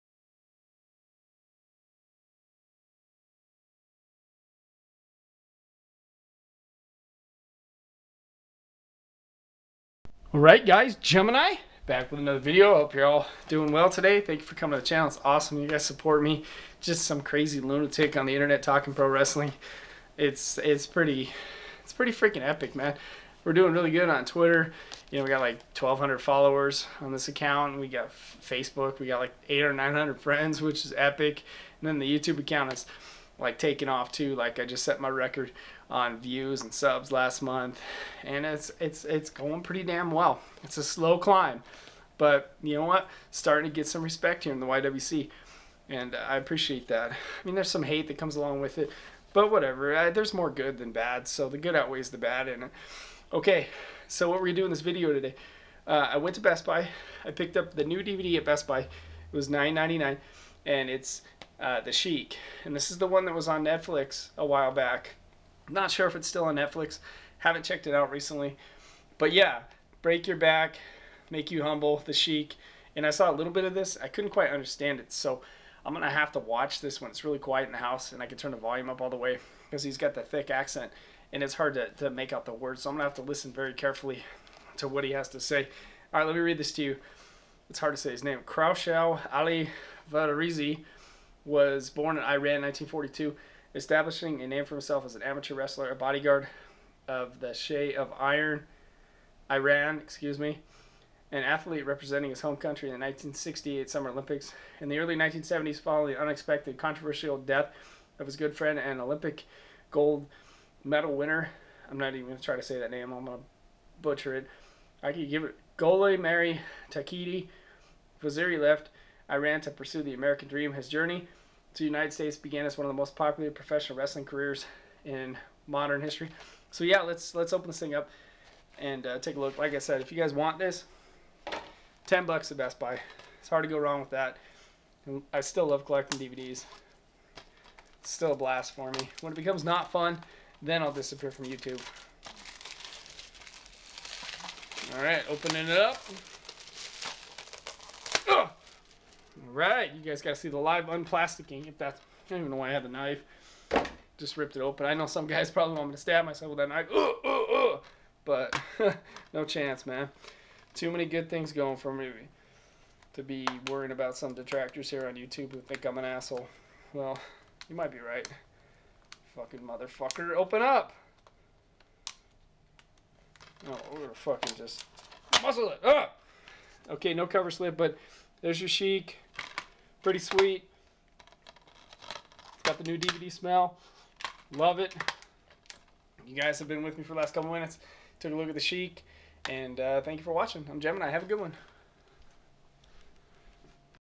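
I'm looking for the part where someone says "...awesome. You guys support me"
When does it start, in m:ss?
0:15.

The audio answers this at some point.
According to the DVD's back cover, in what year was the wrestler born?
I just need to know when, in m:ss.
1:32.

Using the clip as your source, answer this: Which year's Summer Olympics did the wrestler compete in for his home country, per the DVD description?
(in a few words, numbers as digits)
1968.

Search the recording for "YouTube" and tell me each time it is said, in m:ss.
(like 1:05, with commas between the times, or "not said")
0:32, 2:21, 2:45.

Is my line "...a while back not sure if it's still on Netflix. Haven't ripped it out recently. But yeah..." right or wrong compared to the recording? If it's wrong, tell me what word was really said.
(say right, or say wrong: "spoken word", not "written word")
wrong: "checked", not "ripped".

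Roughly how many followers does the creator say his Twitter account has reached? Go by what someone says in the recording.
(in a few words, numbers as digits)
1,200.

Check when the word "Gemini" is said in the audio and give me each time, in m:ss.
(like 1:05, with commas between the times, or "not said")
0:10, 3:10.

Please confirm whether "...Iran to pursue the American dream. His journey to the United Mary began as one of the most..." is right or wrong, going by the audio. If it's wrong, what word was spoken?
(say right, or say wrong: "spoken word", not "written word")
wrong: "States", not "Mary".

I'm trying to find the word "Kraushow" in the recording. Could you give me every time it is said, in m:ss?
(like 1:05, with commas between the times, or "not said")
1:28.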